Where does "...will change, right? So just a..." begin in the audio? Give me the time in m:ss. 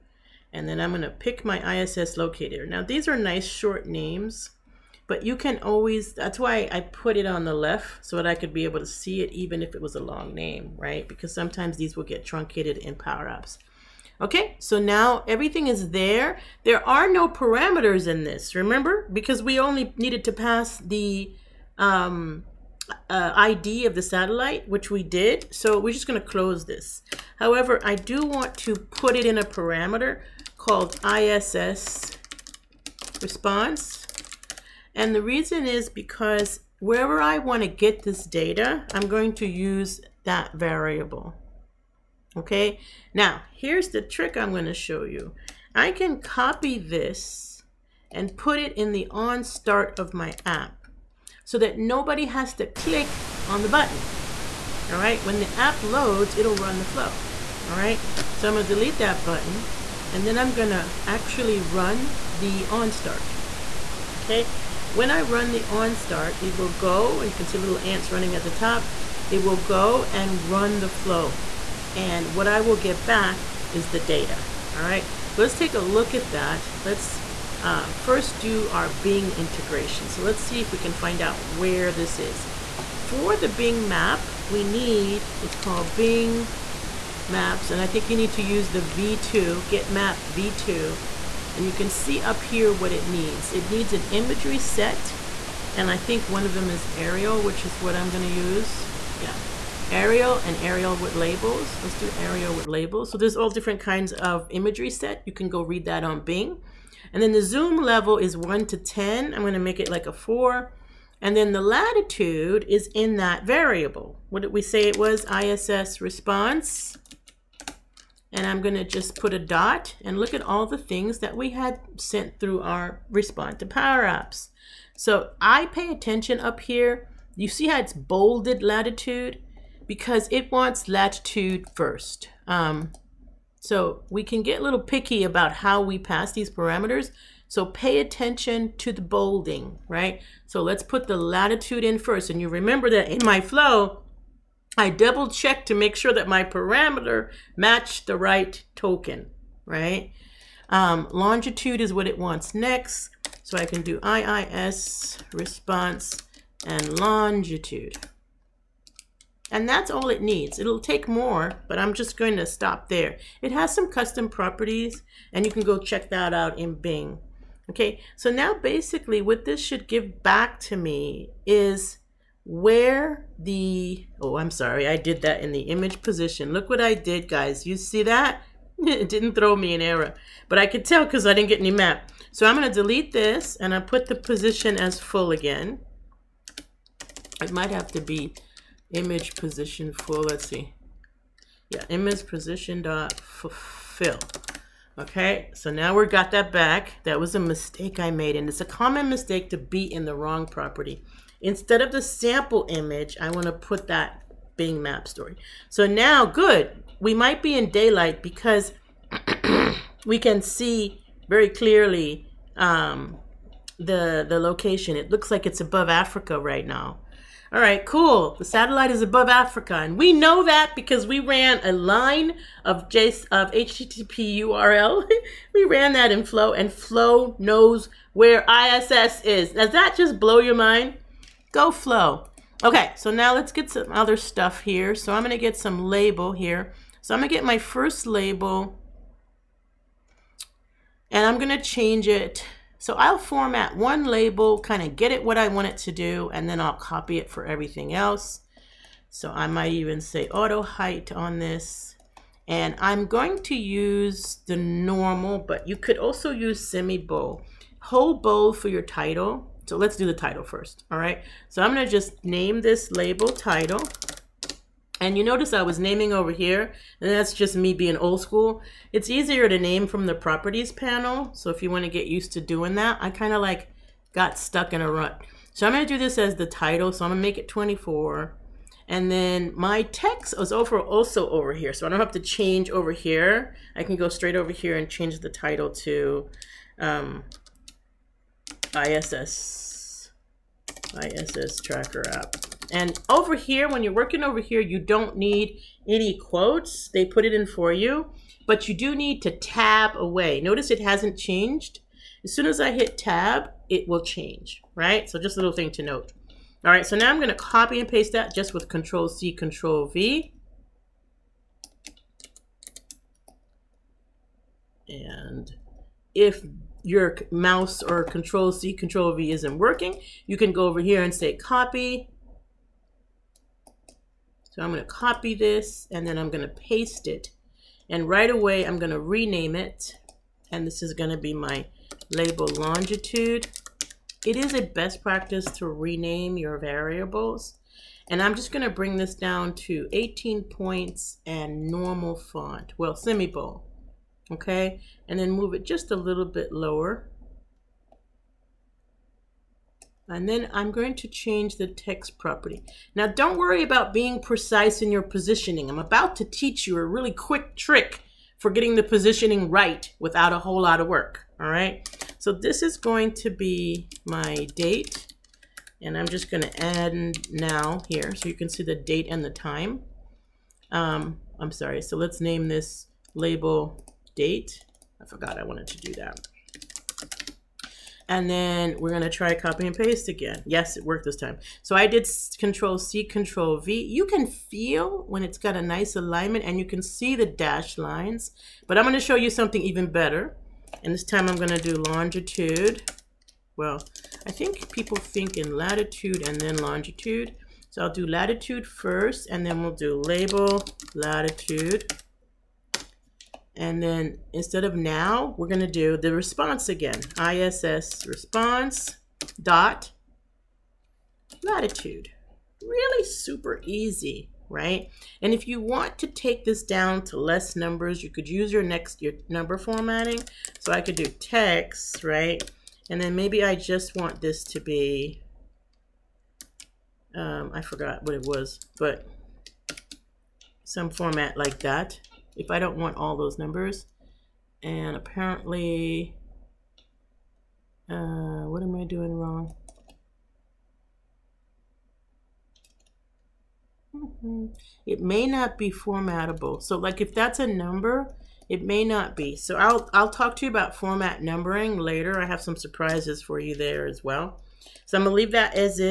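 5:03.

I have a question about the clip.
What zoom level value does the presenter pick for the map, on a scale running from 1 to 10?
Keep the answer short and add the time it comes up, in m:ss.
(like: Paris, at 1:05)
4, at 1:50.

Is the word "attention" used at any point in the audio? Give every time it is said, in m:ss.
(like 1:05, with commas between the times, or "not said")
2:05, 2:18.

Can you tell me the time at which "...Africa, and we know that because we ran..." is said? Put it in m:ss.
3:39.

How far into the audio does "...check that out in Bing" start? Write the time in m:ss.
2:45.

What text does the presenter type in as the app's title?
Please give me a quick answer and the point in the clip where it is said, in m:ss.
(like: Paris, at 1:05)
ISS tracker app, at 4:51.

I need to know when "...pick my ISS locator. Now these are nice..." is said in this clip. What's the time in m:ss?
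0:01.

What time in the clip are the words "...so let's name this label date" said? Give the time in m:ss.
6:11.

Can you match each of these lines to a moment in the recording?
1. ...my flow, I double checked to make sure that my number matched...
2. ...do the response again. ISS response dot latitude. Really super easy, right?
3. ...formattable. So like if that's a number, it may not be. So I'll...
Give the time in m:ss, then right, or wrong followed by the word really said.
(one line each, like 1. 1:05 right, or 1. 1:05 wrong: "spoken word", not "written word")
1. 2:23 wrong: "parameter", not "number"
2. 6:45 right
3. 7:25 right.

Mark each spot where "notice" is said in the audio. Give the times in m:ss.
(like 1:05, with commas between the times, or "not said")
4:25, 5:00.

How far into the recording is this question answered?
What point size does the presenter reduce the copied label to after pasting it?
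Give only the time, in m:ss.
5:39.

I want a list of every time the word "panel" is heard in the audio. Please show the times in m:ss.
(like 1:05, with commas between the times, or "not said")
4:30.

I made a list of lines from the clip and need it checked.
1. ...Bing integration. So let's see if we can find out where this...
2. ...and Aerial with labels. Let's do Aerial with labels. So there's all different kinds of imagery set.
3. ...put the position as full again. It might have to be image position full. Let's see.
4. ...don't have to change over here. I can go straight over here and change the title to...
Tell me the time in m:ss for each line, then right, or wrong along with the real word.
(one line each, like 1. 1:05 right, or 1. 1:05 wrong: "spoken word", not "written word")
1. 1:18 right
2. 1:40 right
3. 3:03 right
4. 4:41 right.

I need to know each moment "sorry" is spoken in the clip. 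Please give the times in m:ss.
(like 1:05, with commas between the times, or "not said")
2:54, 6:11.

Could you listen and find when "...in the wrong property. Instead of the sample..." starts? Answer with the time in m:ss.
3:19.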